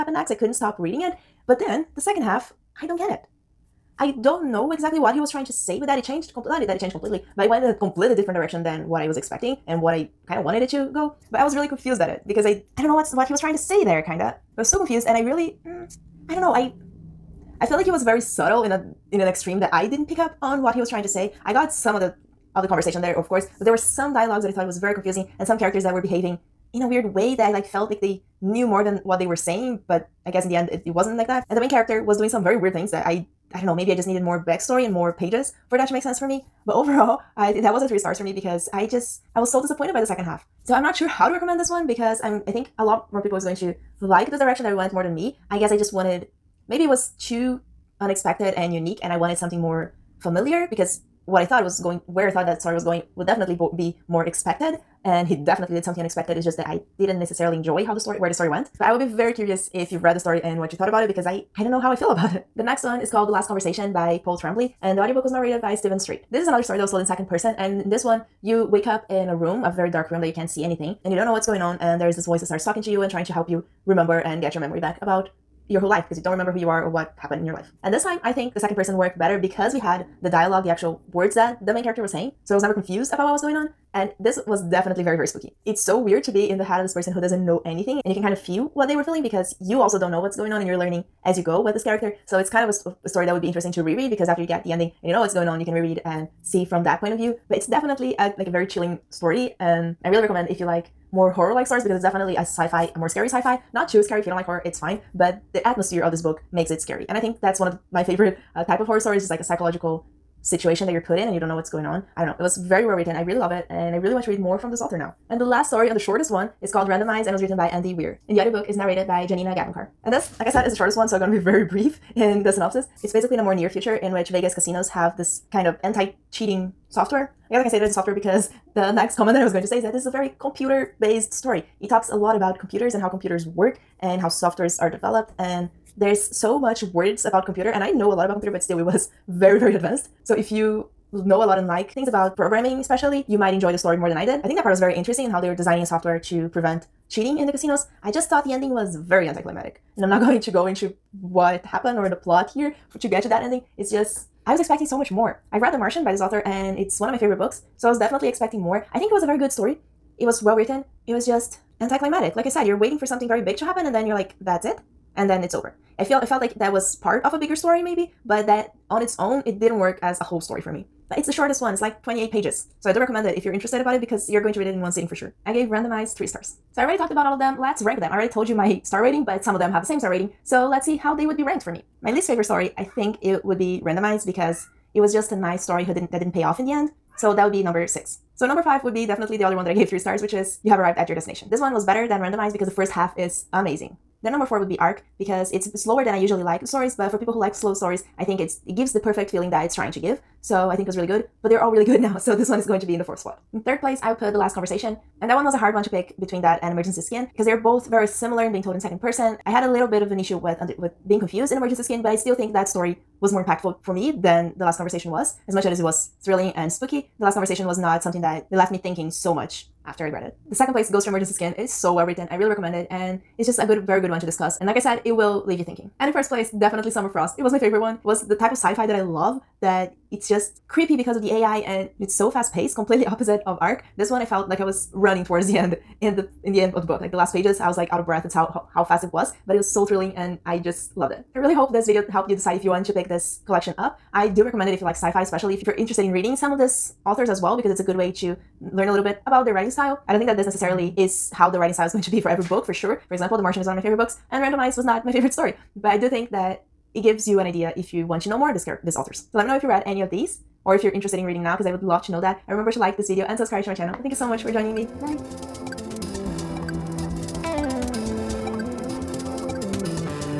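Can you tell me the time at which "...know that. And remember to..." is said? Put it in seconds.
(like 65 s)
262 s.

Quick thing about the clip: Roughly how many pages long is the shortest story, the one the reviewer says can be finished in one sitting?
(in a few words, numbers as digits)
28.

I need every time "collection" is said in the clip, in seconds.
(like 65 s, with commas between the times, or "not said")
243 s.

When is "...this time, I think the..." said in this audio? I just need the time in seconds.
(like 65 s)
77 s.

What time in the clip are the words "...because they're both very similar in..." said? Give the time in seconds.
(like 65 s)
207 s.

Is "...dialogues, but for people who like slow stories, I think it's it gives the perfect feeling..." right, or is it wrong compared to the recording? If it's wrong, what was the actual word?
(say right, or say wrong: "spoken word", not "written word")
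wrong: "stories", not "dialogues".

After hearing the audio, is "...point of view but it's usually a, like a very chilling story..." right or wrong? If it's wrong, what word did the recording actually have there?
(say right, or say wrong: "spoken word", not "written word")
wrong: "definitely", not "usually".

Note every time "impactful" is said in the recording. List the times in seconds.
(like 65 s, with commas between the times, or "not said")
213 s.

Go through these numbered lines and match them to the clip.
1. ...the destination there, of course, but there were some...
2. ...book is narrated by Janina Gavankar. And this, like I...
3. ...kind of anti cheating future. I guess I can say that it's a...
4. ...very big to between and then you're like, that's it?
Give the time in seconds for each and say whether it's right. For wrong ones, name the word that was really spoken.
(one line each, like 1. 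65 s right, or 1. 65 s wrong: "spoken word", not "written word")
1. 22 s wrong: "conversation", not "destination"
2. 118 s right
3. 125 s wrong: "software", not "future"
4. 163 s wrong: "happen", not "between".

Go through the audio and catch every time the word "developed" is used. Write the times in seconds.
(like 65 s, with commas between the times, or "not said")
134 s.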